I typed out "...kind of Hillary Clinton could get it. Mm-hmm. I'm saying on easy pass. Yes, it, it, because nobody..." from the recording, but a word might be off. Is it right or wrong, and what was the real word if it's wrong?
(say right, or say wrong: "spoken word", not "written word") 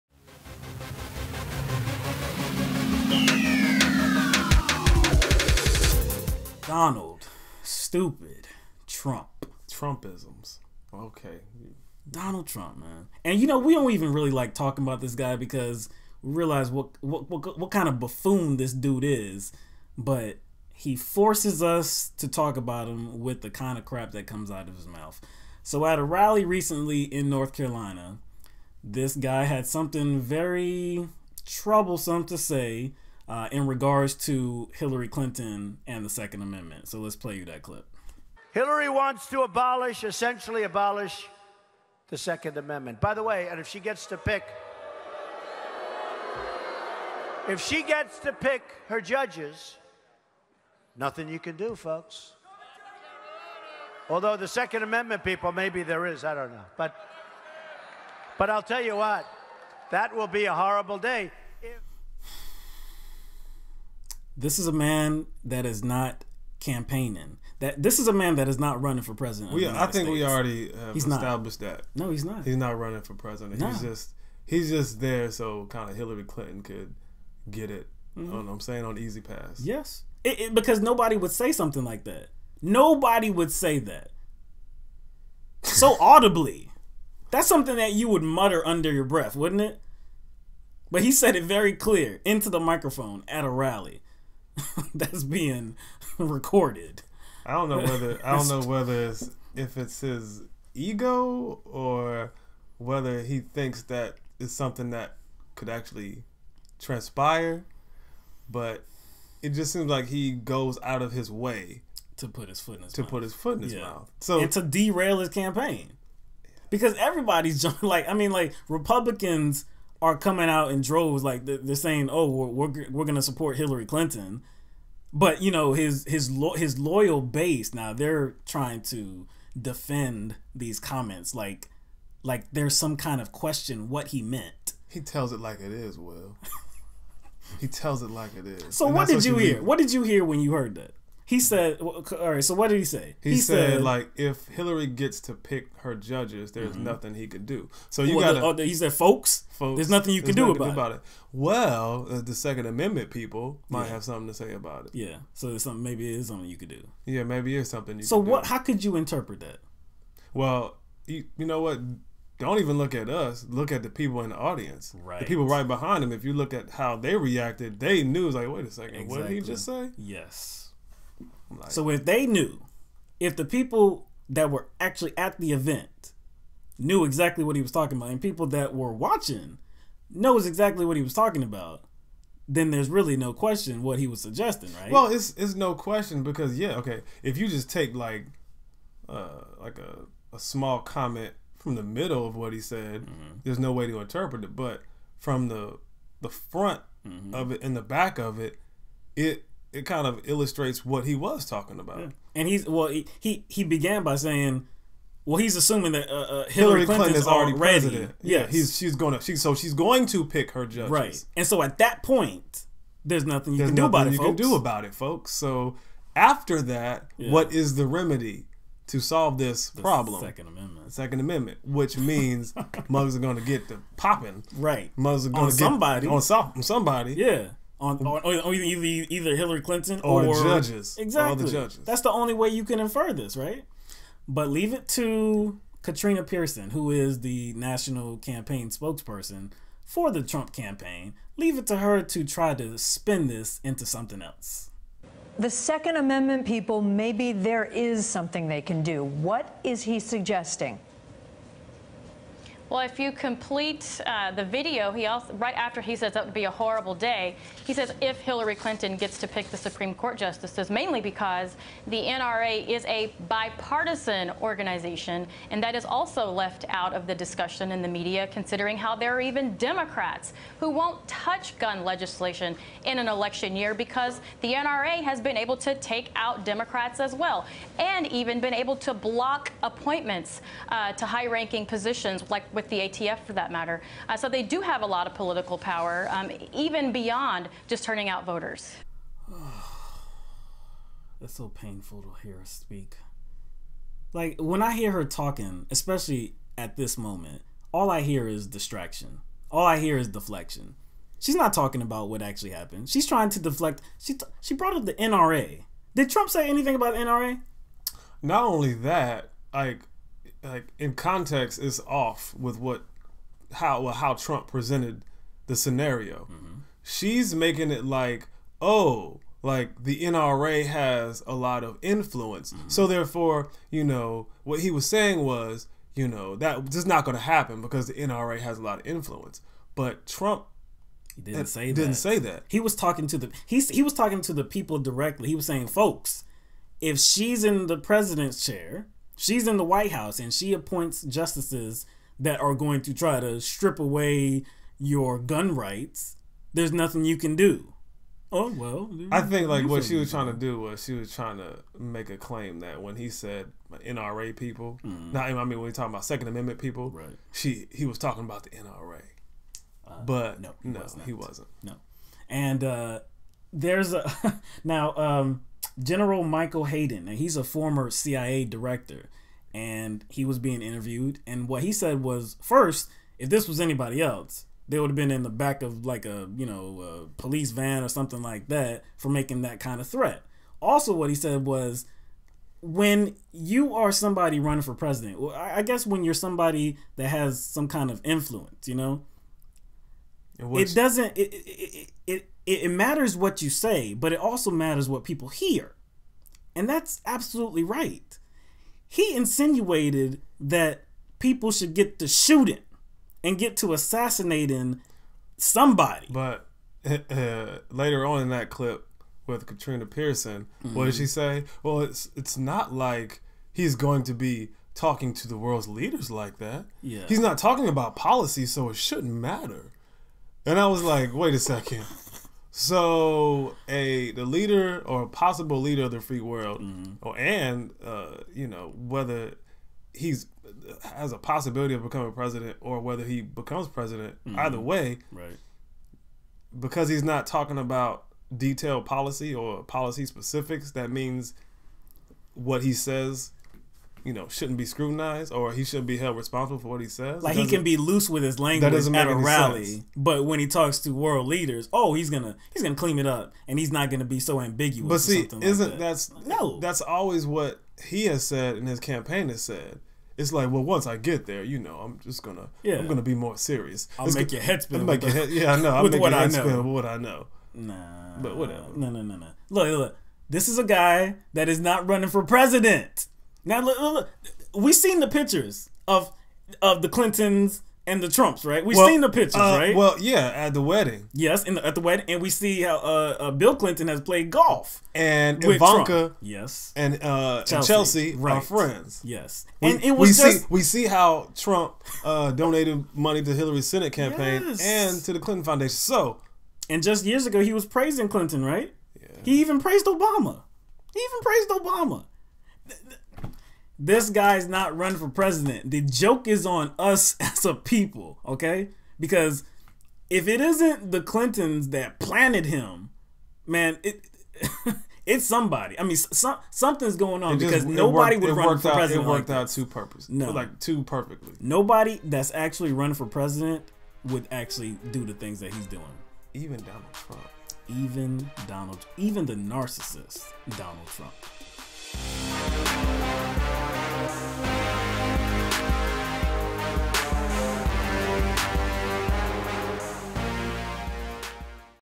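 right.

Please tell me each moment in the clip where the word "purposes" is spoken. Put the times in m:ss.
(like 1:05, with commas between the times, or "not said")
8:39.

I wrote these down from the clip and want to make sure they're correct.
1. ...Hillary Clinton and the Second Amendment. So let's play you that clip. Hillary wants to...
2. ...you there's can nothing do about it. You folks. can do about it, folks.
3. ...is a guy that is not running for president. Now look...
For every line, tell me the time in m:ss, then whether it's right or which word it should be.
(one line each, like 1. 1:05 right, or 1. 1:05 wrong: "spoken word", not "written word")
1. 0:34 right
2. 3:33 right
3. 7:50 right.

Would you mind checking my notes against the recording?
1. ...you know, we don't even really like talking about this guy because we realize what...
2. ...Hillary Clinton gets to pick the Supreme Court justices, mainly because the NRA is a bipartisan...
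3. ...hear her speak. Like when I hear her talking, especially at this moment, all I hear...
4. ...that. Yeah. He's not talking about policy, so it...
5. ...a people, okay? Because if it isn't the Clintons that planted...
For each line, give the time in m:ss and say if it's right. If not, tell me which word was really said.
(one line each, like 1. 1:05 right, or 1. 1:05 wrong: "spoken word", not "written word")
1. 0:13 right
2. 4:18 right
3. 4:52 right
4. 6:56 right
5. 8:27 right.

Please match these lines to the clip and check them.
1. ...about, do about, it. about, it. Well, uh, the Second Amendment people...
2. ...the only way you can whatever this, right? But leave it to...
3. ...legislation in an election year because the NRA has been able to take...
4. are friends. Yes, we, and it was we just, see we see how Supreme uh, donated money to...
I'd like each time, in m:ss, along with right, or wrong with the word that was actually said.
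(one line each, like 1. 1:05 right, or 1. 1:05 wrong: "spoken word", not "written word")
1. 2:30 right
2. 3:52 wrong: "infer", not "whatever"
3. 4:31 right
4. 8:08 wrong: "Trump", not "Supreme".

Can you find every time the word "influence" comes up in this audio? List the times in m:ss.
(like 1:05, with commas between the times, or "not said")
5:21, 5:28, 6:28.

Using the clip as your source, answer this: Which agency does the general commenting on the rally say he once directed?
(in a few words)
CIA.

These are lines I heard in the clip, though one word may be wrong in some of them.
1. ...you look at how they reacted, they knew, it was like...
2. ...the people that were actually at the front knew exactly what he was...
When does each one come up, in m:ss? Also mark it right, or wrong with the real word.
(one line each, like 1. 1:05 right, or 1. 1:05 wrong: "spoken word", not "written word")
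1. 2:46 right
2. 2:53 wrong: "event", not "front".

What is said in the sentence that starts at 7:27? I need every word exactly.
Like he can be loose with his language at a rally, sense.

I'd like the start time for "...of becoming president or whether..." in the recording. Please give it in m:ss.
7:11.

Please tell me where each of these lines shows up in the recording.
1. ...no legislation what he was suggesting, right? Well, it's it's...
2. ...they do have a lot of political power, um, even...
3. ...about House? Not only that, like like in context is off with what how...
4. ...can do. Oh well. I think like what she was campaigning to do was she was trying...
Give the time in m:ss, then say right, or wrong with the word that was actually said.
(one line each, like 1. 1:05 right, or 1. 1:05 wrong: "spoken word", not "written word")
1. 3:03 wrong: "question", not "legislation"
2. 4:44 right
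3. 5:06 wrong: "NRA", not "House"
4. 5:47 wrong: "trying", not "campaigning".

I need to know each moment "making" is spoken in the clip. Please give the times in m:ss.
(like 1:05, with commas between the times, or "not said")
5:17, 6:19.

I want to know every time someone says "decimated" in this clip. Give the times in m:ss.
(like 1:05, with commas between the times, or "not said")
not said.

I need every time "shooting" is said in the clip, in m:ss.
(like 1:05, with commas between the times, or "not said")
6:42.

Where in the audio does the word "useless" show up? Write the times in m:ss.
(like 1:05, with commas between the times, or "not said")
not said.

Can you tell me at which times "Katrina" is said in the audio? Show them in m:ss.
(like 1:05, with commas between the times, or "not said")
3:55, 6:49.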